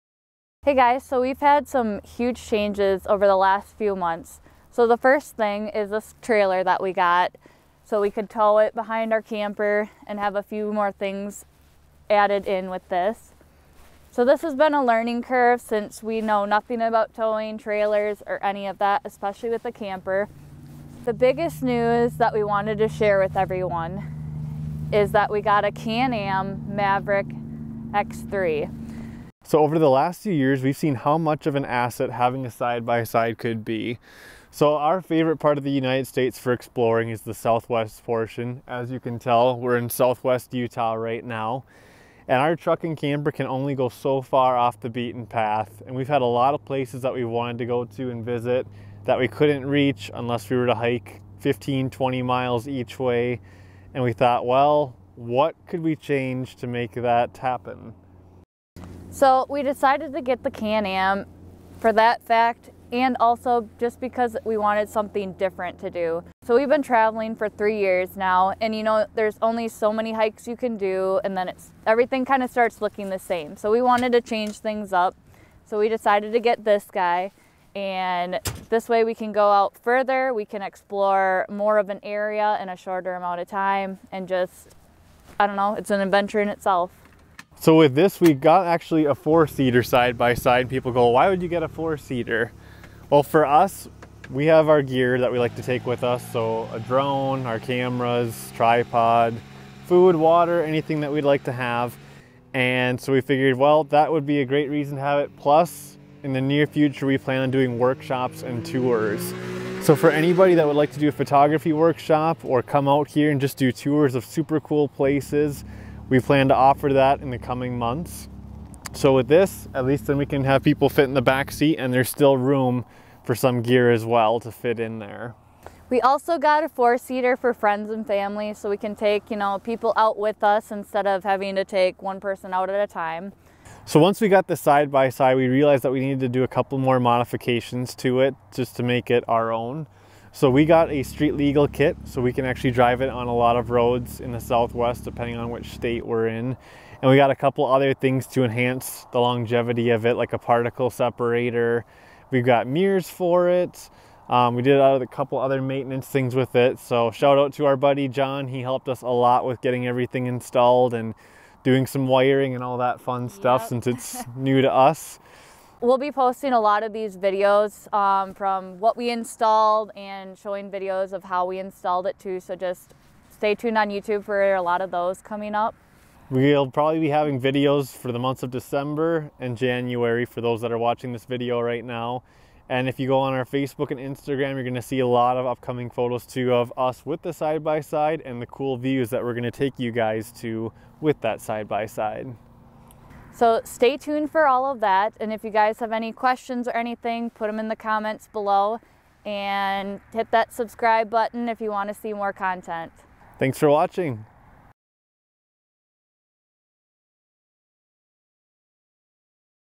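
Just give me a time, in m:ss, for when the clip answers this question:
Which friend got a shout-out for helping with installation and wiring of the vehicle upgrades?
2:38.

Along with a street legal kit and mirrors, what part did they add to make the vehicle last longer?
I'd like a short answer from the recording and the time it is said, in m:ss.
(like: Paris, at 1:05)
particle separator, at 2:30.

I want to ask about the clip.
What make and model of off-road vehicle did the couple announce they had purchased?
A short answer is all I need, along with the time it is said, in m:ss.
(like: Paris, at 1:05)
Can-Am Maverick X3, at 0:25.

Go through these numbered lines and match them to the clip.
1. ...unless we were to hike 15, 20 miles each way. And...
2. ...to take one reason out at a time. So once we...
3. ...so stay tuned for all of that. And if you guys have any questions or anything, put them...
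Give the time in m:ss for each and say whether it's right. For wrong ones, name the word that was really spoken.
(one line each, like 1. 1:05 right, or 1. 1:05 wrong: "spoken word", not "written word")
1. 0:50 right
2. 2:11 wrong: "person", not "reason"
3. 3:13 right.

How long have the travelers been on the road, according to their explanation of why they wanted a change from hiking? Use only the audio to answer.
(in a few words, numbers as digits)
3 years.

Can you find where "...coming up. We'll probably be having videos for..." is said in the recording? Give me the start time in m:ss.
2:55.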